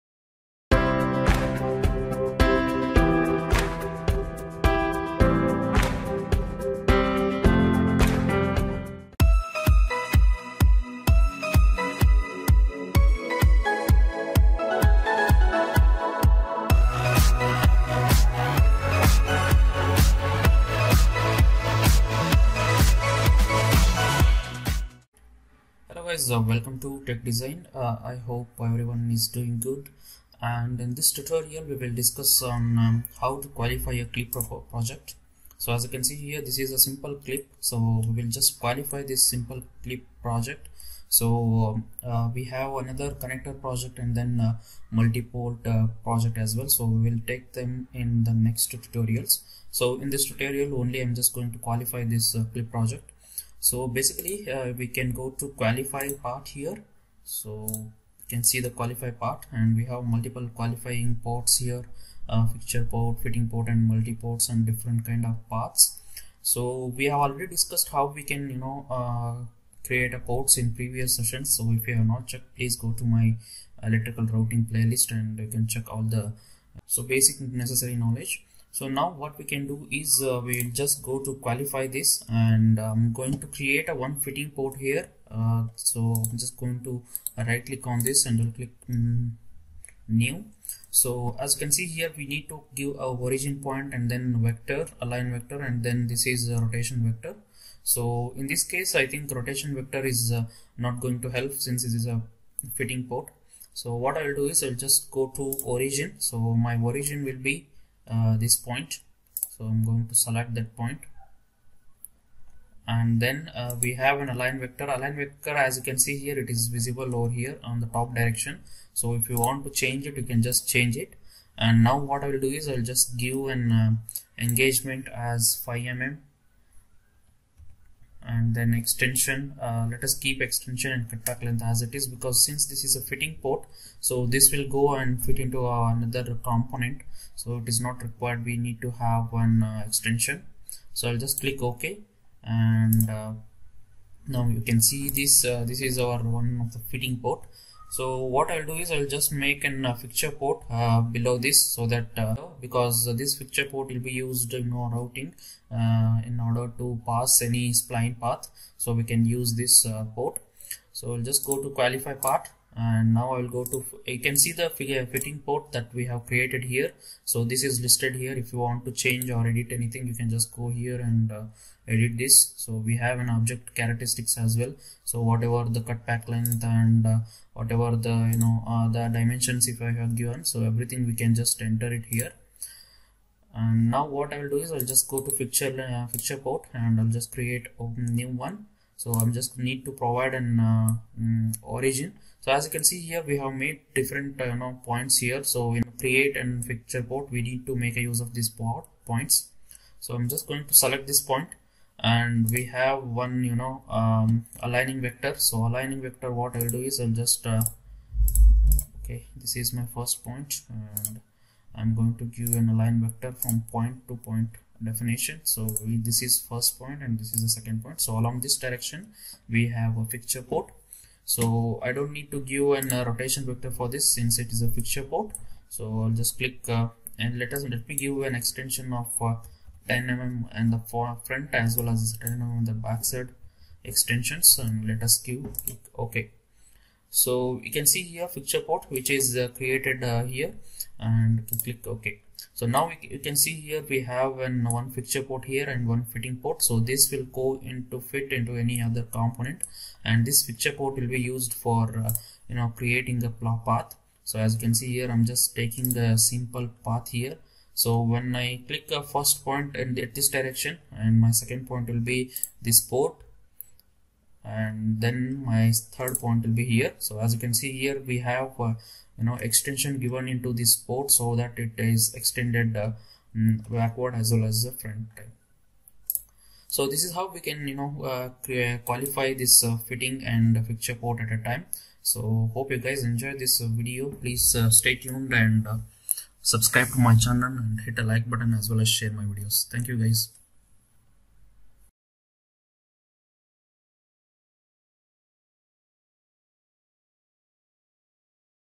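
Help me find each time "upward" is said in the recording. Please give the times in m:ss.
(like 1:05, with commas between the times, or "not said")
not said.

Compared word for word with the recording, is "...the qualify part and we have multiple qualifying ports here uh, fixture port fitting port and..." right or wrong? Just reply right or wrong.
right.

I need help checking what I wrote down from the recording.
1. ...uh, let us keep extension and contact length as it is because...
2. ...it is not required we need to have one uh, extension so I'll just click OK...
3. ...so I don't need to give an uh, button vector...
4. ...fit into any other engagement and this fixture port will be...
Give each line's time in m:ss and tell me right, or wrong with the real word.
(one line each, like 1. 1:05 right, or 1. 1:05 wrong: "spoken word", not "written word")
1. 2:09 right
2. 2:17 right
3. 3:41 wrong: "rotation", not "button"
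4. 4:08 wrong: "component", not "engagement".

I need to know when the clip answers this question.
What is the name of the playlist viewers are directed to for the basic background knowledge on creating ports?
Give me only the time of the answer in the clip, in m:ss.
1:13.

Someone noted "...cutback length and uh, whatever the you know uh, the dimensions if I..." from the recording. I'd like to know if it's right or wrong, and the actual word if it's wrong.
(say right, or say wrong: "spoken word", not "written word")
right.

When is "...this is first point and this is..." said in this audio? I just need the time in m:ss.
3:35.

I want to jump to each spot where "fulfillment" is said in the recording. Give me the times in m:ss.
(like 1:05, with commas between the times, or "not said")
not said.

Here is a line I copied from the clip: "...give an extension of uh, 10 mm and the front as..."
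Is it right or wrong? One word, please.
right.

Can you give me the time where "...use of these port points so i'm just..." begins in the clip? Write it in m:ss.
3:18.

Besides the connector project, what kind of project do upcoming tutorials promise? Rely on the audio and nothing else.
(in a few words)
multi-port.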